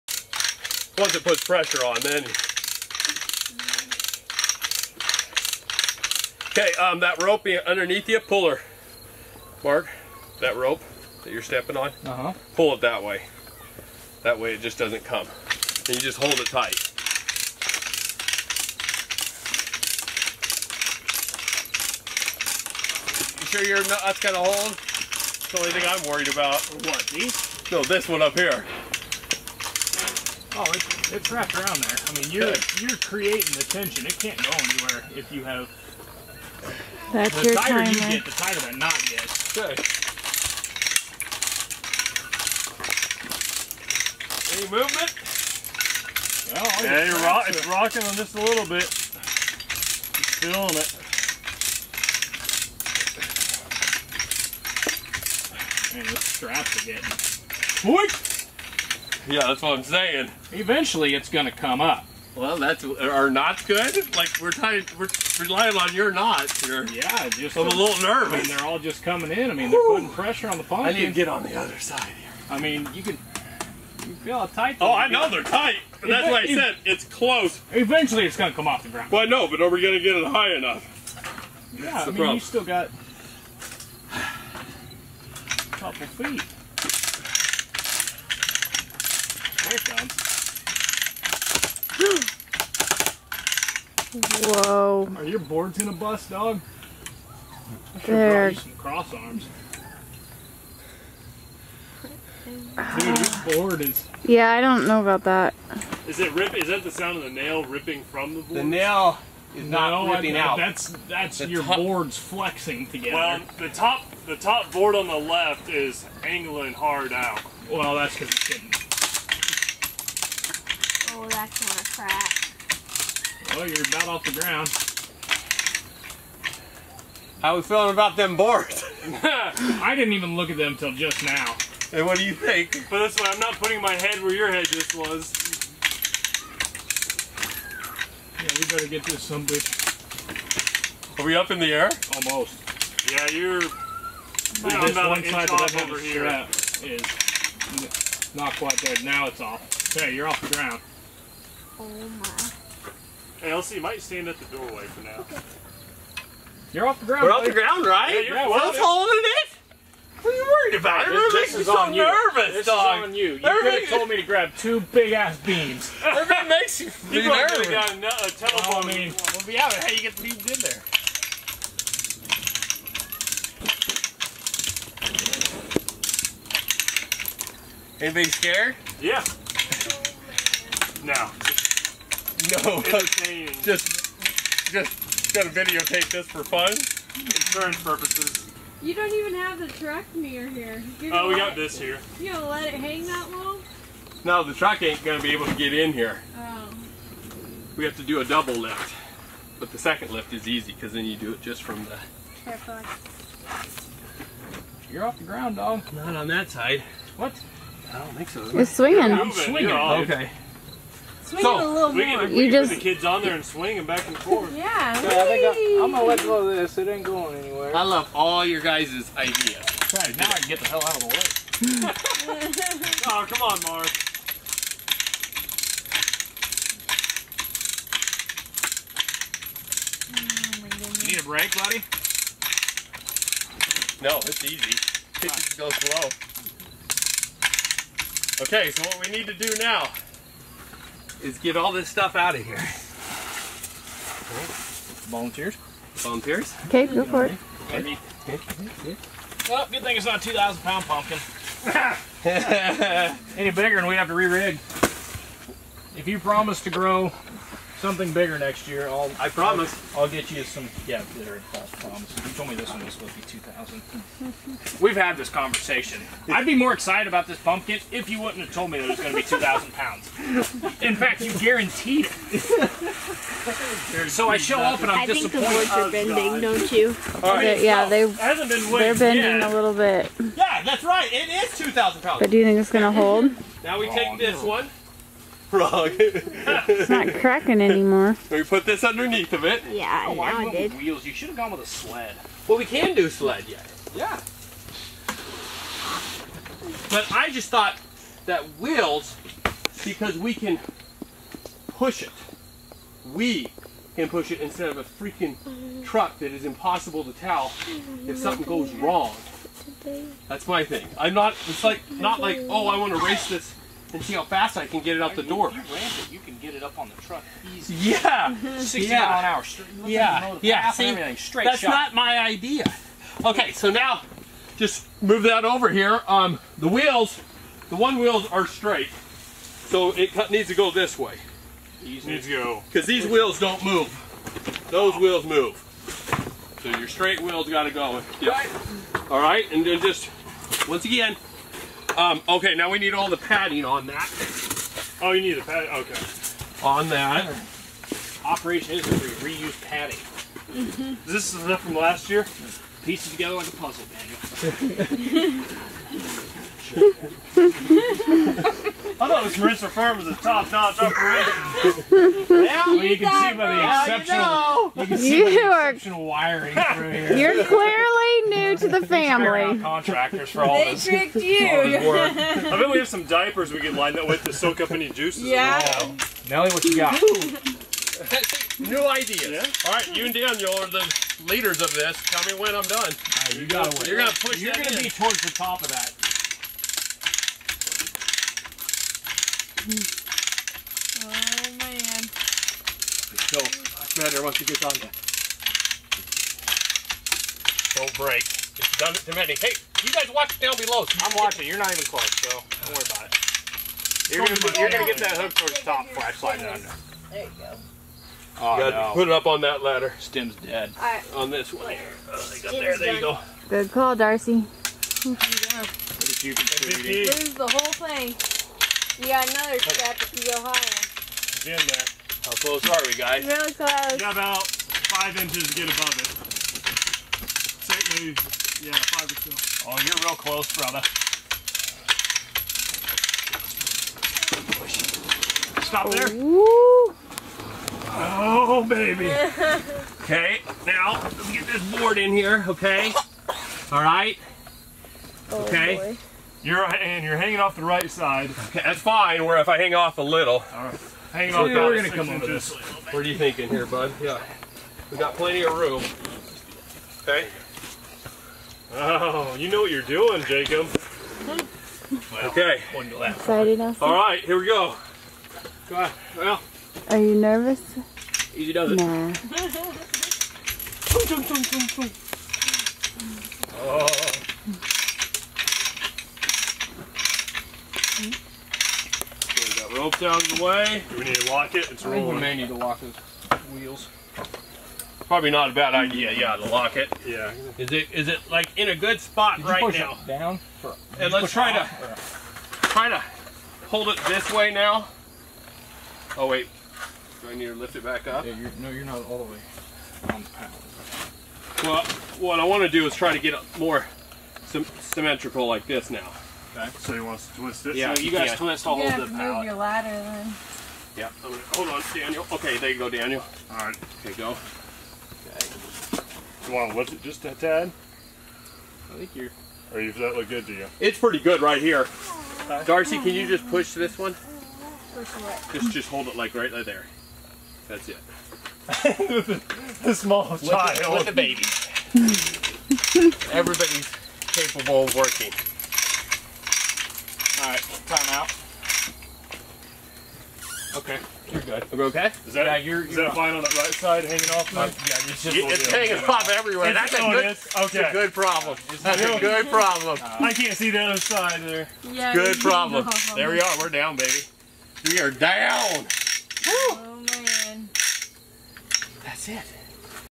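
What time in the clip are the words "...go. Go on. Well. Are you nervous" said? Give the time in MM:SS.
07:44.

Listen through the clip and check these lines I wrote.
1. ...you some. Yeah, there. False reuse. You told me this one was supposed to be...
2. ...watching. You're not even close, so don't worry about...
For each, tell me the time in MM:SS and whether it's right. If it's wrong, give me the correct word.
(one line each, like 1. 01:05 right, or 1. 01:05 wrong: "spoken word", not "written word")
1. 04:20 wrong: "promise", not "reuse"
2. 06:41 right.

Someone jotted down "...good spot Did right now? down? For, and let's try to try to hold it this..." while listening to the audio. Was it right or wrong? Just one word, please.
right.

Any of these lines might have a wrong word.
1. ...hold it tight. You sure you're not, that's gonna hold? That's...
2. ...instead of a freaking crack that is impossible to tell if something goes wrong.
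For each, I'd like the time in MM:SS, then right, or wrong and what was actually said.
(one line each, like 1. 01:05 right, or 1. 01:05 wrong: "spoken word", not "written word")
1. 00:16 right
2. 05:04 wrong: "truck", not "crack".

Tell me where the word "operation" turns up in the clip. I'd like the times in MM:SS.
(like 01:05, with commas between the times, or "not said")
05:48, 06:00.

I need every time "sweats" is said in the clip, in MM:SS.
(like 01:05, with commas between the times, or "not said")
not said.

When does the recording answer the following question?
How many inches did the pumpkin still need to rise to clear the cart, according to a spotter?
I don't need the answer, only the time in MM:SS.
07:04.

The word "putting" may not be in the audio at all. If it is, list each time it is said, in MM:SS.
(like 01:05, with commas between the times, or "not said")
01:09, 02:13.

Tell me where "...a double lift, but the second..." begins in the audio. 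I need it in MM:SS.
03:18.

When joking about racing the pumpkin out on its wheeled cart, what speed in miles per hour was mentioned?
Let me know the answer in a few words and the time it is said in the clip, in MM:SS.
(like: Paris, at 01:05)
60, at 05:18.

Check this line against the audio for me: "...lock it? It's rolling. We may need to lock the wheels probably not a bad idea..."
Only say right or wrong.
right.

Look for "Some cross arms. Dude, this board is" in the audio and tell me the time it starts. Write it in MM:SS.
01:38.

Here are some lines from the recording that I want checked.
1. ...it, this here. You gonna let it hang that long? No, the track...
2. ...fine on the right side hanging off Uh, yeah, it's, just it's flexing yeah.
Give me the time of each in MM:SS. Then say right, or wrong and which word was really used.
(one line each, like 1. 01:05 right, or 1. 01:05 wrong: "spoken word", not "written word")
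1. 03:11 wrong: "truck", not "track"
2. 09:03 wrong: "hanging", not "flexing".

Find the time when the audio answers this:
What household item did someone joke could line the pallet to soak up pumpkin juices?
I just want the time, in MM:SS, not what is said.
06:13.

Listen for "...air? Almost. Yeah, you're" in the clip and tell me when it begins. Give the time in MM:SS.
02:21.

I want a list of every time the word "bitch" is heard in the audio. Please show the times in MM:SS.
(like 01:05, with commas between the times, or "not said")
02:19.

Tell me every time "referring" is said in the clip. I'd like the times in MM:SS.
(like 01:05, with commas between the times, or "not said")
not said.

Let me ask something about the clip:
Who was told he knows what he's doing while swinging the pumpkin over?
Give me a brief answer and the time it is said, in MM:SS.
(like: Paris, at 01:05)
Jacob, at 07:40.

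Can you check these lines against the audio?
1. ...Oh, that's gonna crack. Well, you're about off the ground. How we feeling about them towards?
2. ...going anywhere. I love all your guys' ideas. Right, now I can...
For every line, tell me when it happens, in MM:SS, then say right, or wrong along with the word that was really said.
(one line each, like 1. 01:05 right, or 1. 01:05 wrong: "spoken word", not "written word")
1. 02:01 wrong: "boards", not "towards"
2. 03:37 right.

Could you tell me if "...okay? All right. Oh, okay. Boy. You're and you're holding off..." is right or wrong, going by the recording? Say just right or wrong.
wrong.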